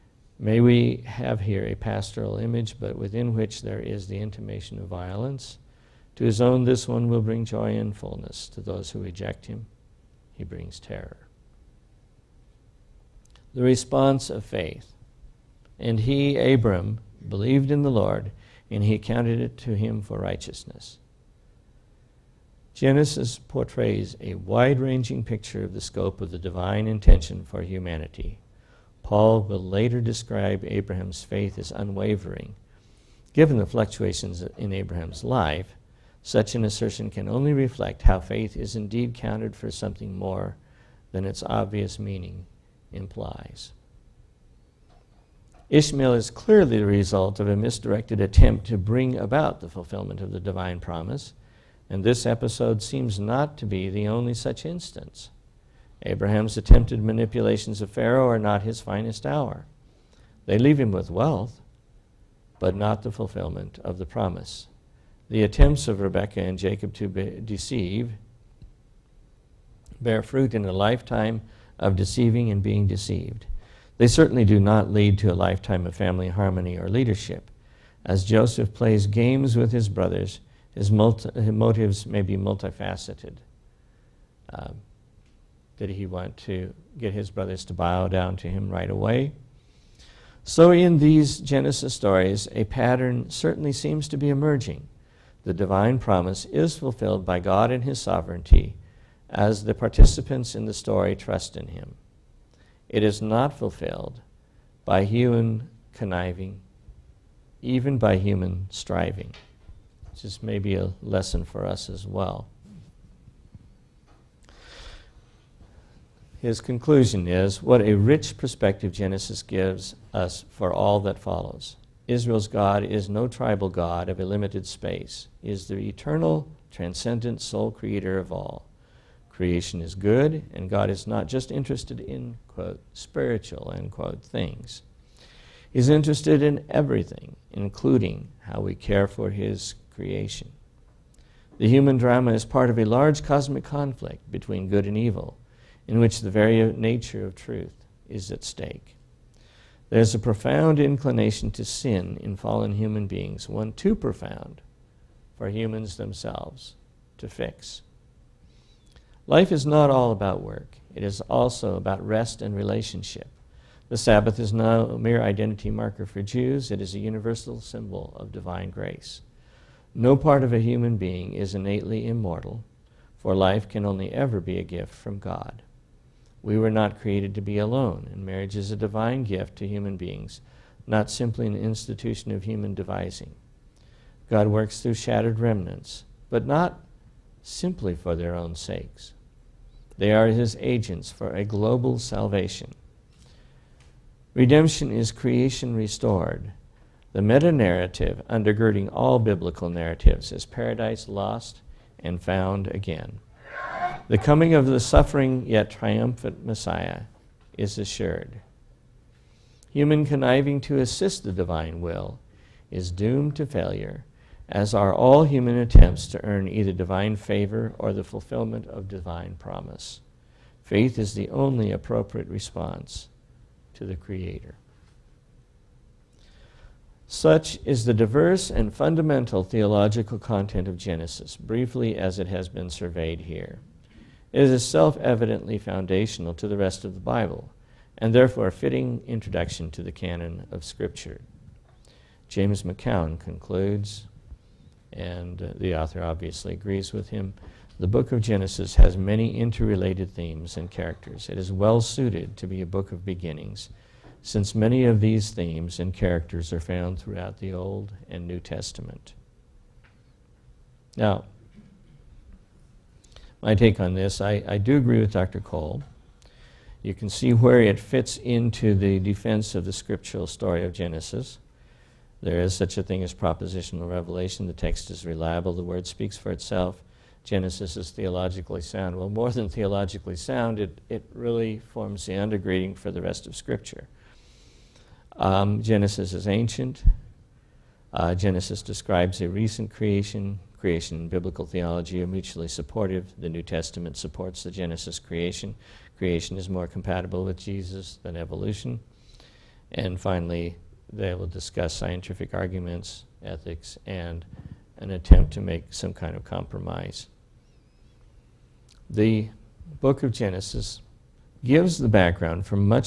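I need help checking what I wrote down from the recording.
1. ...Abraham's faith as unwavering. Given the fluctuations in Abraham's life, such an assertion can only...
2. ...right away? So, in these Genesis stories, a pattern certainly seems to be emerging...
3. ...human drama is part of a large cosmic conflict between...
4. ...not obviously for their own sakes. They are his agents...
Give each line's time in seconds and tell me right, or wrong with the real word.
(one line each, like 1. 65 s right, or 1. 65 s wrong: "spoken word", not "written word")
1. 30 s right
2. 88 s right
3. 141 s right
4. 186 s wrong: "simply", not "obviously".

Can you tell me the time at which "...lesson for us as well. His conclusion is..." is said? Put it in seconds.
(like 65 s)
111 s.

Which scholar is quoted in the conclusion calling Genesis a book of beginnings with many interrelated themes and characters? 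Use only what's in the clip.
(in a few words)
James McKeown.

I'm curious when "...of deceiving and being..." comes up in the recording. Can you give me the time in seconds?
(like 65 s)
71 s.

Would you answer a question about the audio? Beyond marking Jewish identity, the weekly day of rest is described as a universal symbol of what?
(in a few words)
Divine grace.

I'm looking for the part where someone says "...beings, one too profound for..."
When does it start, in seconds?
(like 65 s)
153 s.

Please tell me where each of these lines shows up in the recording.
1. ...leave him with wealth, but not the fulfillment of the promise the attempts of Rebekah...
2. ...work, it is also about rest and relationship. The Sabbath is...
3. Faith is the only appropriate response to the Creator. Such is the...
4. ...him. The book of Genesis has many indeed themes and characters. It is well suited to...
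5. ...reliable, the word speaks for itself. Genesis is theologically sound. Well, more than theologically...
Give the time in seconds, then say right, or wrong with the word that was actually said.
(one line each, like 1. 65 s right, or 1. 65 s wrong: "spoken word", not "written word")
1. 60 s right
2. 160 s right
3. 220 s right
4. 247 s wrong: "interrelated", not "indeed"
5. 275 s right.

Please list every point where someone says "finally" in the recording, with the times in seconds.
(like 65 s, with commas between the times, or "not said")
299 s.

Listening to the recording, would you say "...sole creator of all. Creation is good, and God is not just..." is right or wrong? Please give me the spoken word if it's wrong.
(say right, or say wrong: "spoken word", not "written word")
right.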